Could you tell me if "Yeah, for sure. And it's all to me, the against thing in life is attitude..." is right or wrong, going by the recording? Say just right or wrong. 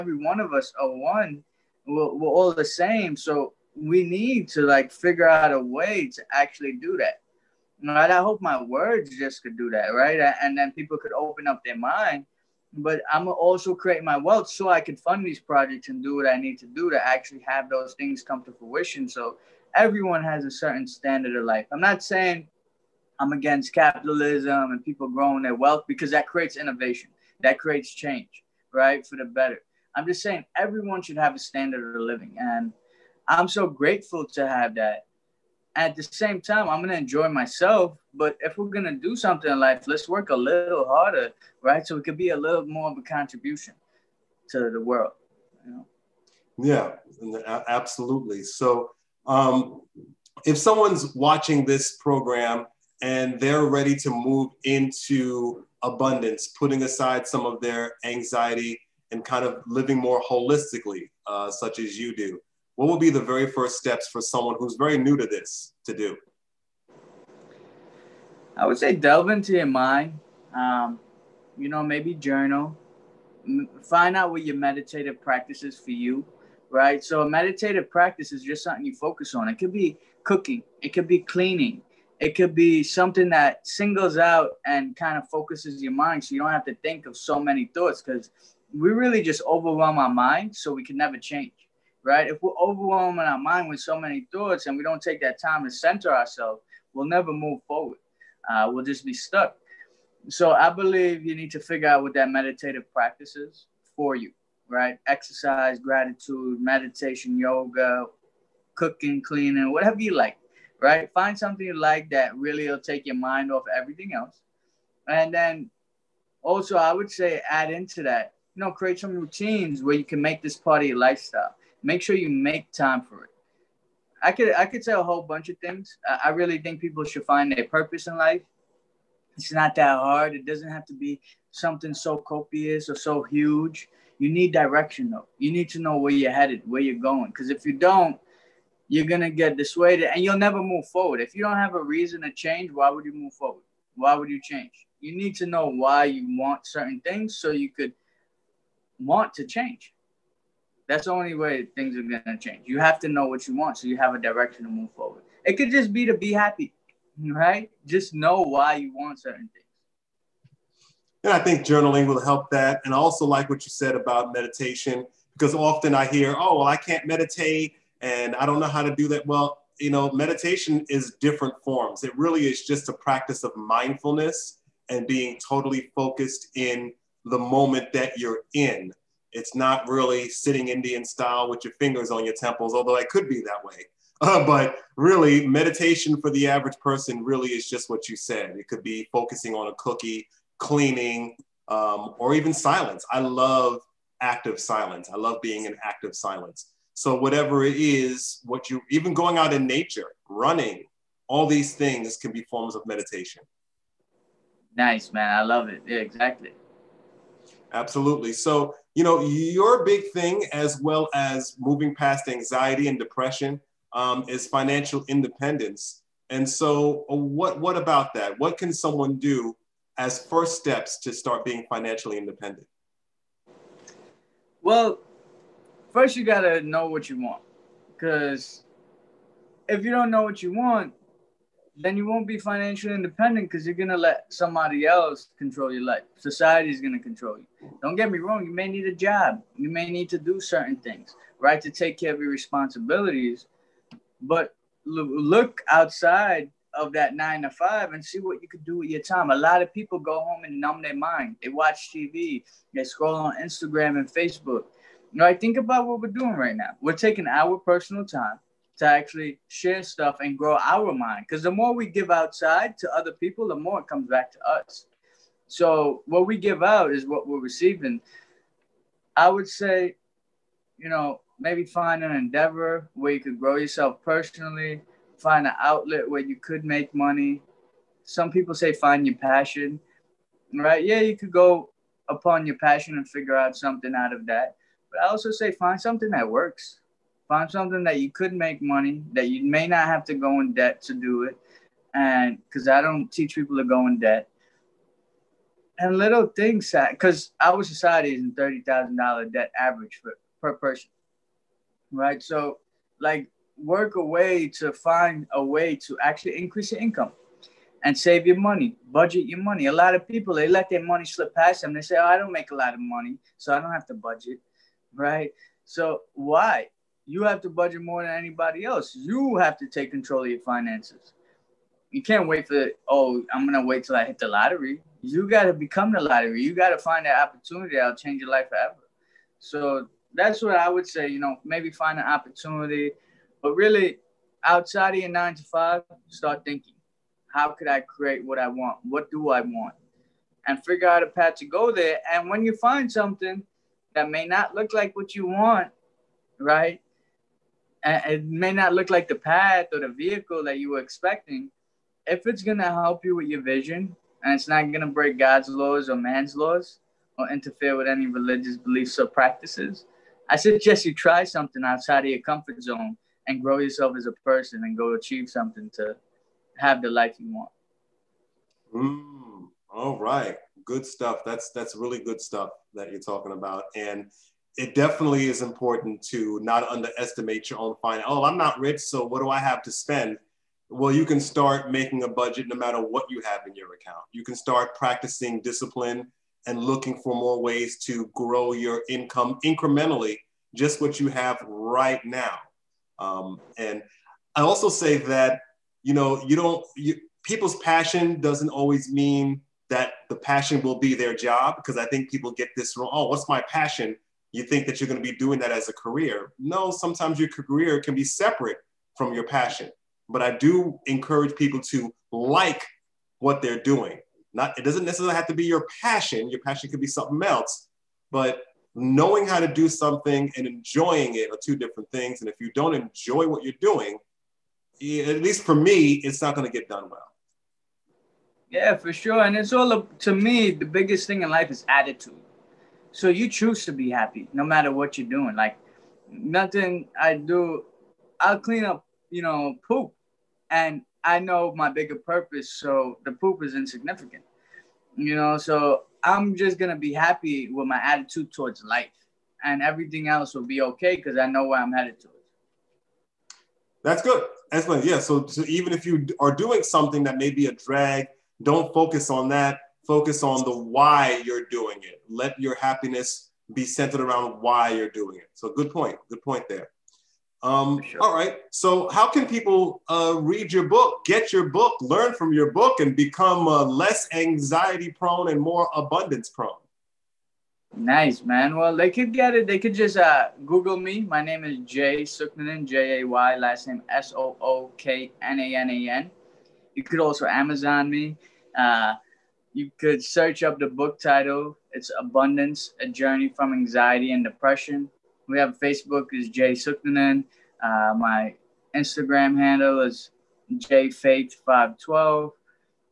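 wrong.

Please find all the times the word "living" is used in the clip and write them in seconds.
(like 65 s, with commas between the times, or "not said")
32 s, 59 s.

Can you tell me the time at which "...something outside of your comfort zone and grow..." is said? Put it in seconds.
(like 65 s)
361 s.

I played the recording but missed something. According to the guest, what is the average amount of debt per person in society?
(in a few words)
$30,000.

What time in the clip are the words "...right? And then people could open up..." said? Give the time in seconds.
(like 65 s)
9 s.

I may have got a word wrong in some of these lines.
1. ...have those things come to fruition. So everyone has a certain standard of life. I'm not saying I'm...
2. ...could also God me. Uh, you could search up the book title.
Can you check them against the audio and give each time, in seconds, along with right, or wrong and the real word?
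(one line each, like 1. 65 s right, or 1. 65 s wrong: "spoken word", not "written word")
1. 17 s right
2. 486 s wrong: "Amazon", not "God".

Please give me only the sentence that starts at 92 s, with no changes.
If we're overwhelming our mind with so many thoughts and we don't take that time to center ourselves, we'll never move forward.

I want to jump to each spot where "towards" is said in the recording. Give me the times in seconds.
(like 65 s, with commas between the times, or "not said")
448 s.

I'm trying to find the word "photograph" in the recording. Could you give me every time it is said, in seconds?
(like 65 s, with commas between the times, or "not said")
not said.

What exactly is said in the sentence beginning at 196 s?
So whatever it is, what you even going out in nature, running, all these things can be forms of meditation.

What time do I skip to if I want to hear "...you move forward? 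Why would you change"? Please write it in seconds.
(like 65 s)
143 s.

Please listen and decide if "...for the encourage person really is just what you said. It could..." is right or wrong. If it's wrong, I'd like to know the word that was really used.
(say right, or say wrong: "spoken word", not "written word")
wrong: "average", not "encourage".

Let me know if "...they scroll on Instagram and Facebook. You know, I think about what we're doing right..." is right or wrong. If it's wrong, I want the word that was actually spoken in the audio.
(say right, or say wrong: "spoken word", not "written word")
right.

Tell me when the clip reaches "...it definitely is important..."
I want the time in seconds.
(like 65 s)
374 s.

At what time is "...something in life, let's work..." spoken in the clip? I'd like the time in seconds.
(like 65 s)
39 s.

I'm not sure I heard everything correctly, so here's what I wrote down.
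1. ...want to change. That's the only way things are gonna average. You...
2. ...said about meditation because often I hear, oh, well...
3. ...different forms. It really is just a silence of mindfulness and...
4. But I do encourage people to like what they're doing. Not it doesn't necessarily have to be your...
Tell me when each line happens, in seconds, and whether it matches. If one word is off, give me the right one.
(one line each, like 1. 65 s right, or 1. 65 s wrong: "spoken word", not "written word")
1. 148 s wrong: "change", not "average"
2. 163 s right
3. 171 s wrong: "practice", not "silence"
4. 410 s right.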